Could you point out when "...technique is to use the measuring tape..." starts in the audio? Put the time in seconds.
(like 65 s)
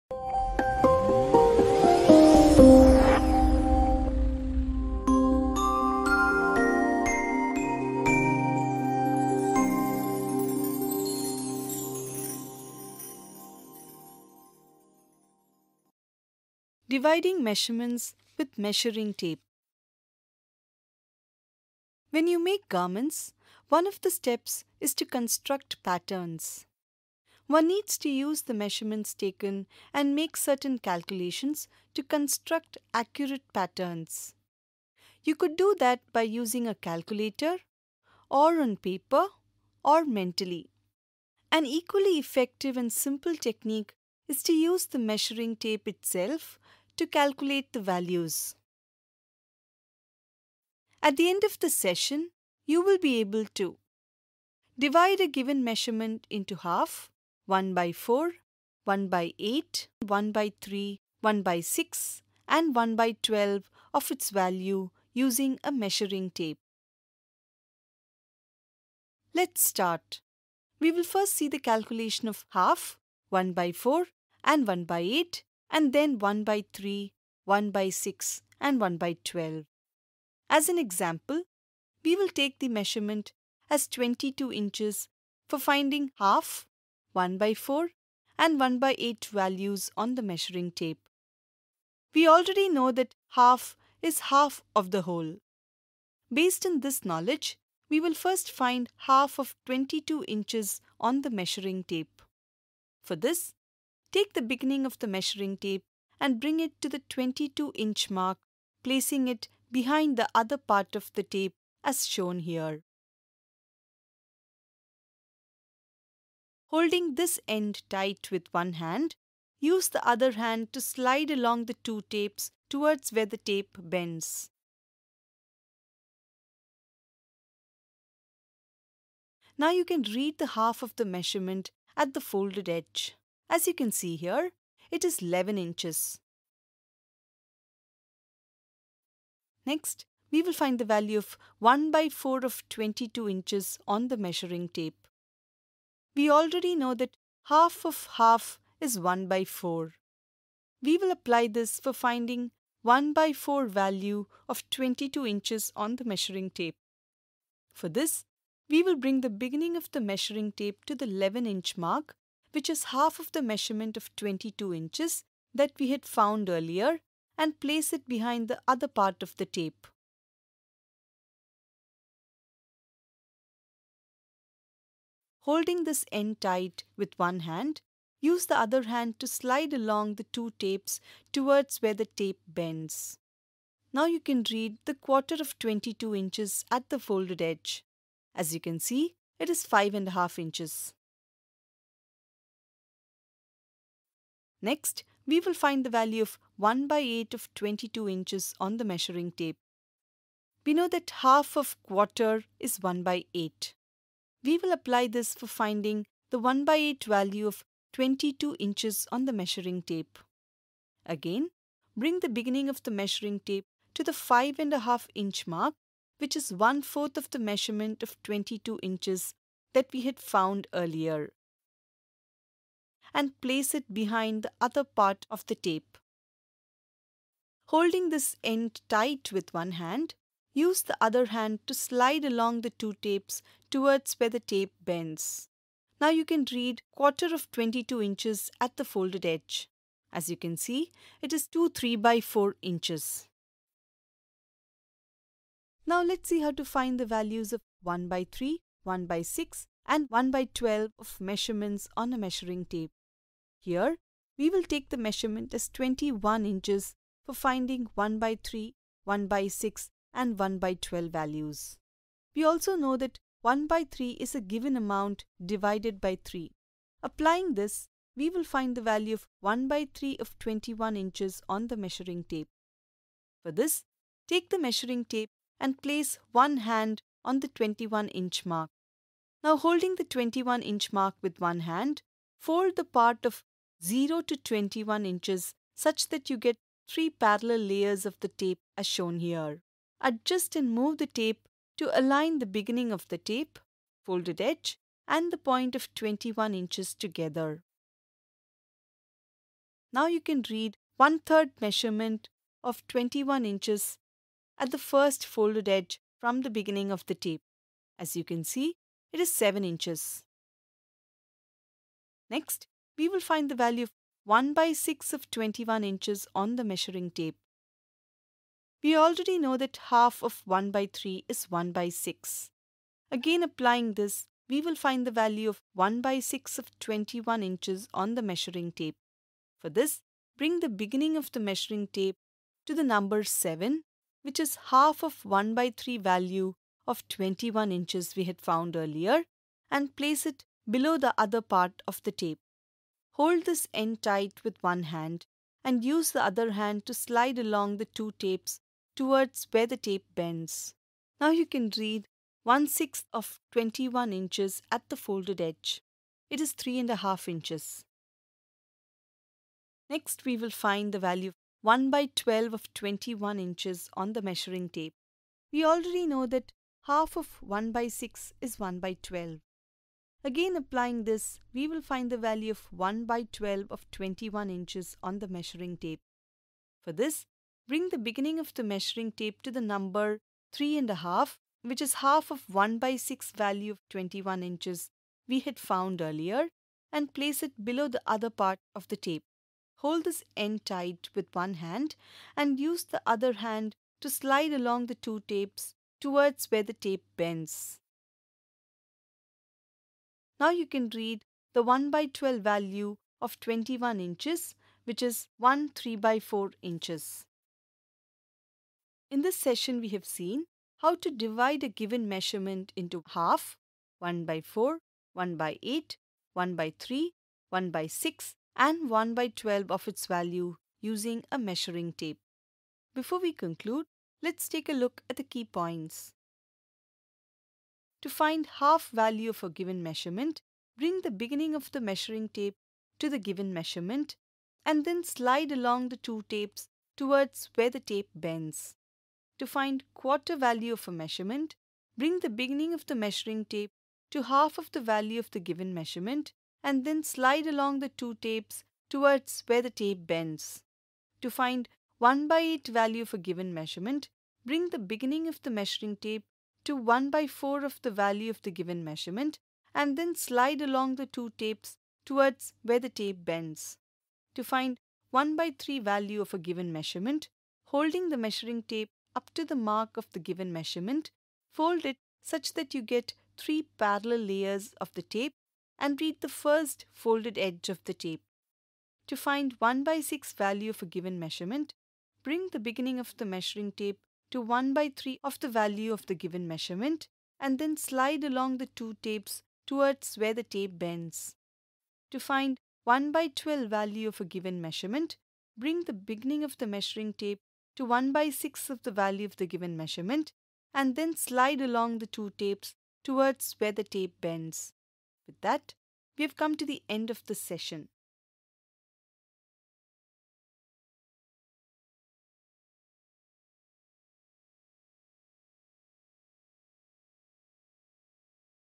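43 s.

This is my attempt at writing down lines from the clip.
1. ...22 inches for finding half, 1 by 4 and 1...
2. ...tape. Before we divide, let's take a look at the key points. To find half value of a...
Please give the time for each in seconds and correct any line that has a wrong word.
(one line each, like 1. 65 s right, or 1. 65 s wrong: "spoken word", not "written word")
1. 83 s right
2. 421 s wrong: "conclude", not "divide".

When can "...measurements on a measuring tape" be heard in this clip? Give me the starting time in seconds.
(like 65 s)
251 s.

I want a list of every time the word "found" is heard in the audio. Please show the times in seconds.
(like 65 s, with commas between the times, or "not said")
166 s, 220 s, 338 s, 385 s.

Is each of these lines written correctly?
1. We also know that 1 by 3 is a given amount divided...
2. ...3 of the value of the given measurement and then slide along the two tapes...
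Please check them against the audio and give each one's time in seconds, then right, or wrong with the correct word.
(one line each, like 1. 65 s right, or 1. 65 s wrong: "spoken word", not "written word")
1. 262 s right
2. 484 s right.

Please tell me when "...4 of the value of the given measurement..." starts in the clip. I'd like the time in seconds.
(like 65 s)
457 s.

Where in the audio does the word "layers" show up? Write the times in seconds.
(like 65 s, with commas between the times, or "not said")
287 s, 474 s.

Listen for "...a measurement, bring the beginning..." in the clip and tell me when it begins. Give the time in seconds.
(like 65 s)
440 s.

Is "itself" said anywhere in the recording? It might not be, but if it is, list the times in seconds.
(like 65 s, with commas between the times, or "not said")
45 s.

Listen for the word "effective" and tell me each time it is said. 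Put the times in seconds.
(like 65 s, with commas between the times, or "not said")
42 s.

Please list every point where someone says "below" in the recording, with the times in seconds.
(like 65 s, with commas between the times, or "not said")
340 s, 387 s.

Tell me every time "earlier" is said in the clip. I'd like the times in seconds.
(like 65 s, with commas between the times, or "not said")
166 s, 220 s, 338 s, 386 s.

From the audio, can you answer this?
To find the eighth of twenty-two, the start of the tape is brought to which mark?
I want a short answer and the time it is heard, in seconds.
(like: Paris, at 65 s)
5.5 inch, at 214 s.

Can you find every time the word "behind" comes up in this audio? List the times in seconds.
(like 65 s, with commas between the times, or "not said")
109 s, 168 s, 223 s.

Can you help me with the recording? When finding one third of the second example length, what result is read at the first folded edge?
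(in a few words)
7 inches.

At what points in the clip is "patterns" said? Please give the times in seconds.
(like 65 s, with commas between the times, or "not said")
25 s, 33 s.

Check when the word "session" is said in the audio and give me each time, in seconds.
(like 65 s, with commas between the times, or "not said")
51 s, 409 s, 507 s.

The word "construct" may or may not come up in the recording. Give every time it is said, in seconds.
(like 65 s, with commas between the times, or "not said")
25 s, 32 s.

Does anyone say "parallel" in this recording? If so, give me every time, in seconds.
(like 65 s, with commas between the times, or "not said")
287 s, 473 s.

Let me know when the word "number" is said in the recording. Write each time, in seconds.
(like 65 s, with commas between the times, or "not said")
332 s, 379 s.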